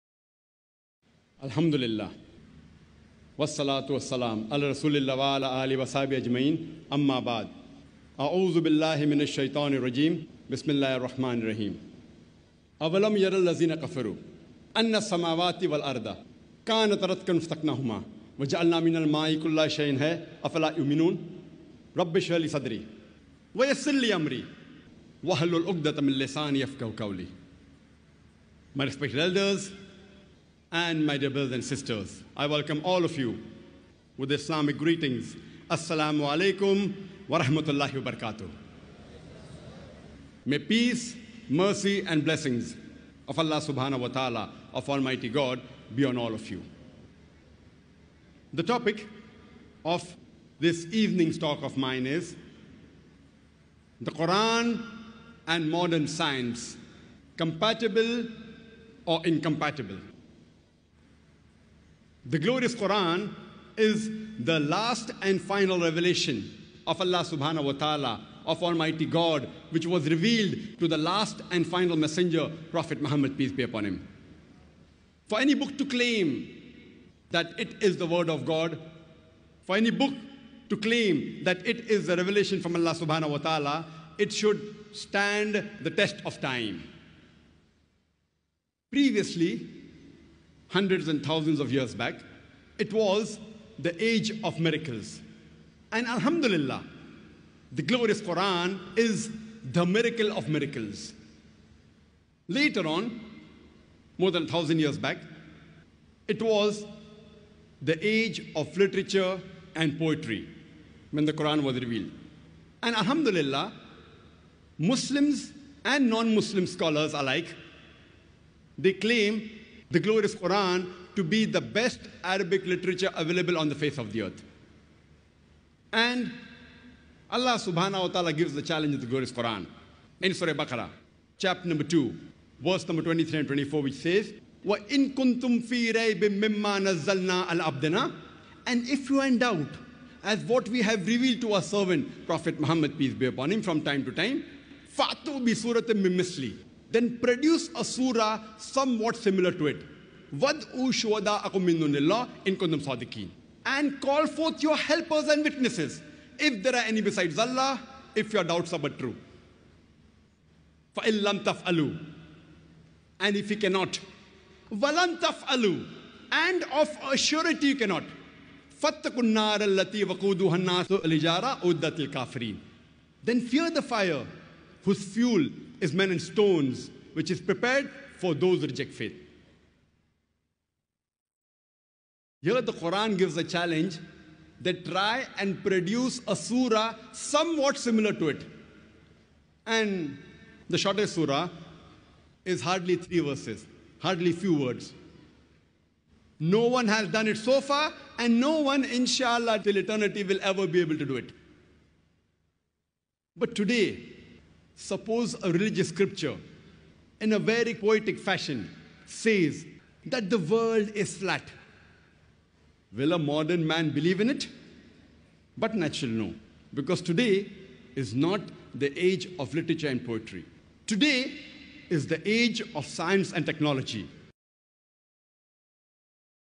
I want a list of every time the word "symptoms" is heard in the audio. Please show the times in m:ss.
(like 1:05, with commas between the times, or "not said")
not said.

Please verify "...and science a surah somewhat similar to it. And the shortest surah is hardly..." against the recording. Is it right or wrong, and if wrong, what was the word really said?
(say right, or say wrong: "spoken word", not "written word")
wrong: "produce", not "science".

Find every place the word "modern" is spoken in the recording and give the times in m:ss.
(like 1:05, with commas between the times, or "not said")
0:55, 3:33.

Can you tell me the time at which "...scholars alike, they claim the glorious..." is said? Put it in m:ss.
1:56.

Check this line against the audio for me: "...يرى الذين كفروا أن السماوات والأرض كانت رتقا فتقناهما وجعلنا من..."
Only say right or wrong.
right.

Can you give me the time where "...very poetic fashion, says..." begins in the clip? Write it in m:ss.
3:27.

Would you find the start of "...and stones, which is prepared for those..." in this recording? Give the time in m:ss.
2:56.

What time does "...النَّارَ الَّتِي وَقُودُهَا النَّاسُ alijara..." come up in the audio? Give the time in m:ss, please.
2:49.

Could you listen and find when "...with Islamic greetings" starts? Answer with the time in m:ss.
0:34.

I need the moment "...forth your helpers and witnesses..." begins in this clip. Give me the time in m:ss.
2:34.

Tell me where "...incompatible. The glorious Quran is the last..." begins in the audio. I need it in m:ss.
0:59.